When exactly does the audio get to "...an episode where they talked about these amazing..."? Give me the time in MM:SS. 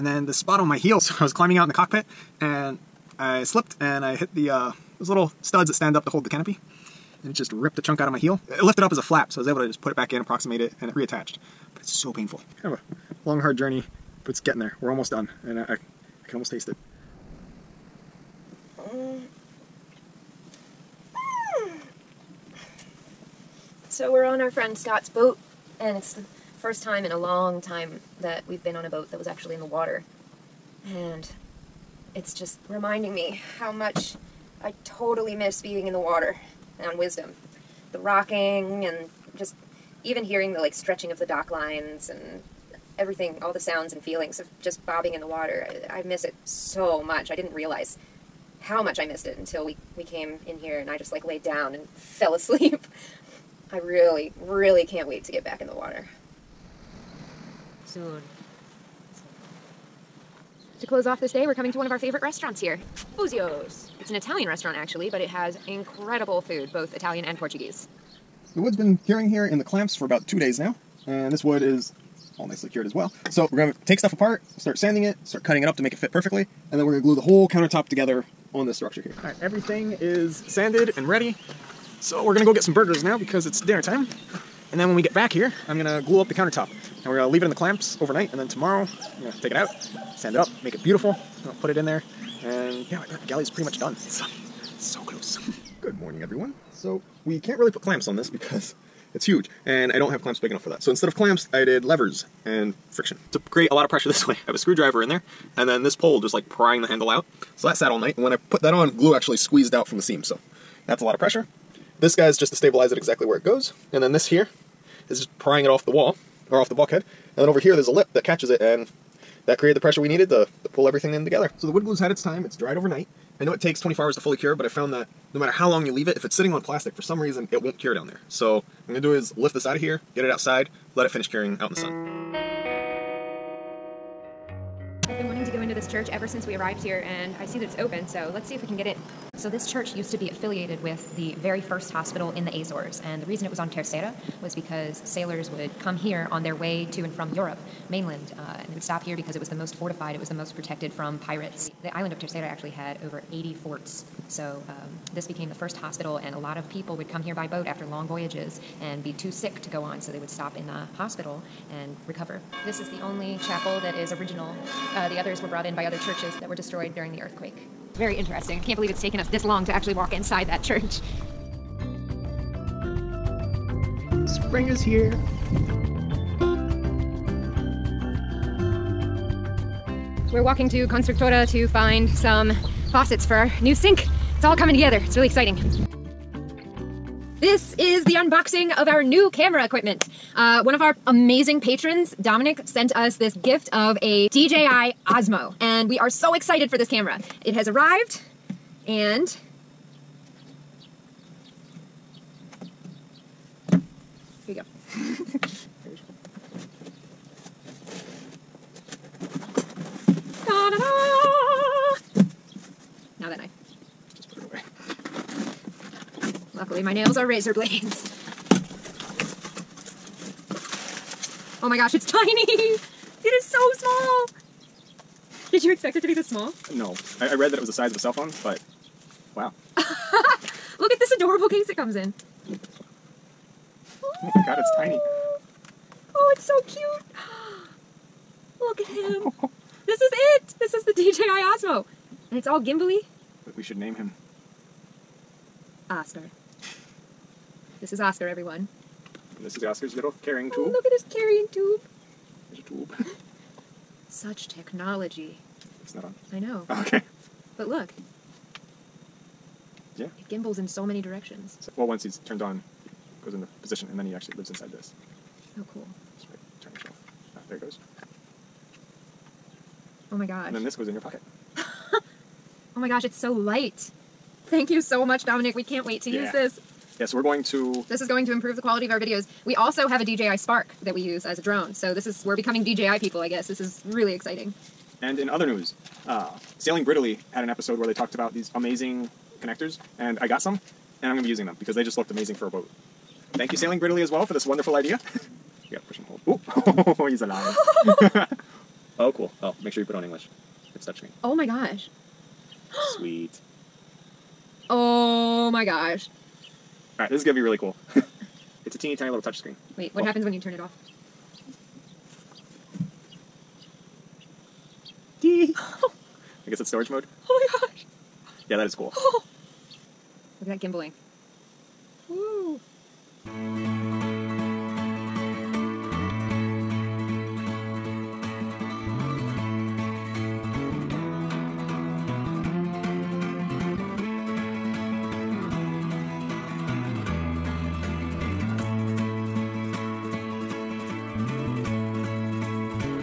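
04:47.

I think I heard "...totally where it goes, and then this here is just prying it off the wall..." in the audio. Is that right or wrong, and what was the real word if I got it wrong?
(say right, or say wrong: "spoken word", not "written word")
wrong: "exactly", not "totally".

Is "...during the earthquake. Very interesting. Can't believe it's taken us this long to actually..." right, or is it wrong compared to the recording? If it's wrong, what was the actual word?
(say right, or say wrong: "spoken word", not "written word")
right.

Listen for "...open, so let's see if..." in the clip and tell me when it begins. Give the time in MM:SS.
02:17.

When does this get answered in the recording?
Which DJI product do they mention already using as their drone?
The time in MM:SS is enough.
04:40.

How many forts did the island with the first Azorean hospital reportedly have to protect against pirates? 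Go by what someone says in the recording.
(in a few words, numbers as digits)
over 80.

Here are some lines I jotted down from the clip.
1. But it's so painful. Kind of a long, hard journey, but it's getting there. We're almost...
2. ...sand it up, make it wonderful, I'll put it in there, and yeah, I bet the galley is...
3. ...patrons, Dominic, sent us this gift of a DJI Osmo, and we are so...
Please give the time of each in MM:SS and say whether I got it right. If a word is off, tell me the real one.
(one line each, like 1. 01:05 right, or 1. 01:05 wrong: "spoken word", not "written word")
1. 00:11 right
2. 01:30 wrong: "beautiful", not "wonderful"
3. 03:11 right.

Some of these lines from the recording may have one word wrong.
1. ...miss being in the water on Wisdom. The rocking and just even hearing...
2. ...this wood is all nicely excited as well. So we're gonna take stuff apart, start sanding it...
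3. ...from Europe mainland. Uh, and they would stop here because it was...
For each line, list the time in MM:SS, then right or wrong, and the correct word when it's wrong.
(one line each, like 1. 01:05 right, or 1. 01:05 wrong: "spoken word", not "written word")
1. 00:35 right
2. 01:11 wrong: "cured", not "excited"
3. 02:27 right.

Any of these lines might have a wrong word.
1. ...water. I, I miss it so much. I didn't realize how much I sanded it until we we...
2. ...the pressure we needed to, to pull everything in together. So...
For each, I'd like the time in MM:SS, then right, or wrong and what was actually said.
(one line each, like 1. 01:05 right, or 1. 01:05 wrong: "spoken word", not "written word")
1. 00:45 wrong: "missed", not "sanded"
2. 01:59 right.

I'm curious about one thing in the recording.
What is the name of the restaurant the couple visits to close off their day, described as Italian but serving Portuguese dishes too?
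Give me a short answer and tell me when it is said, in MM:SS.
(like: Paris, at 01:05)
Capuzio's, at 01:03.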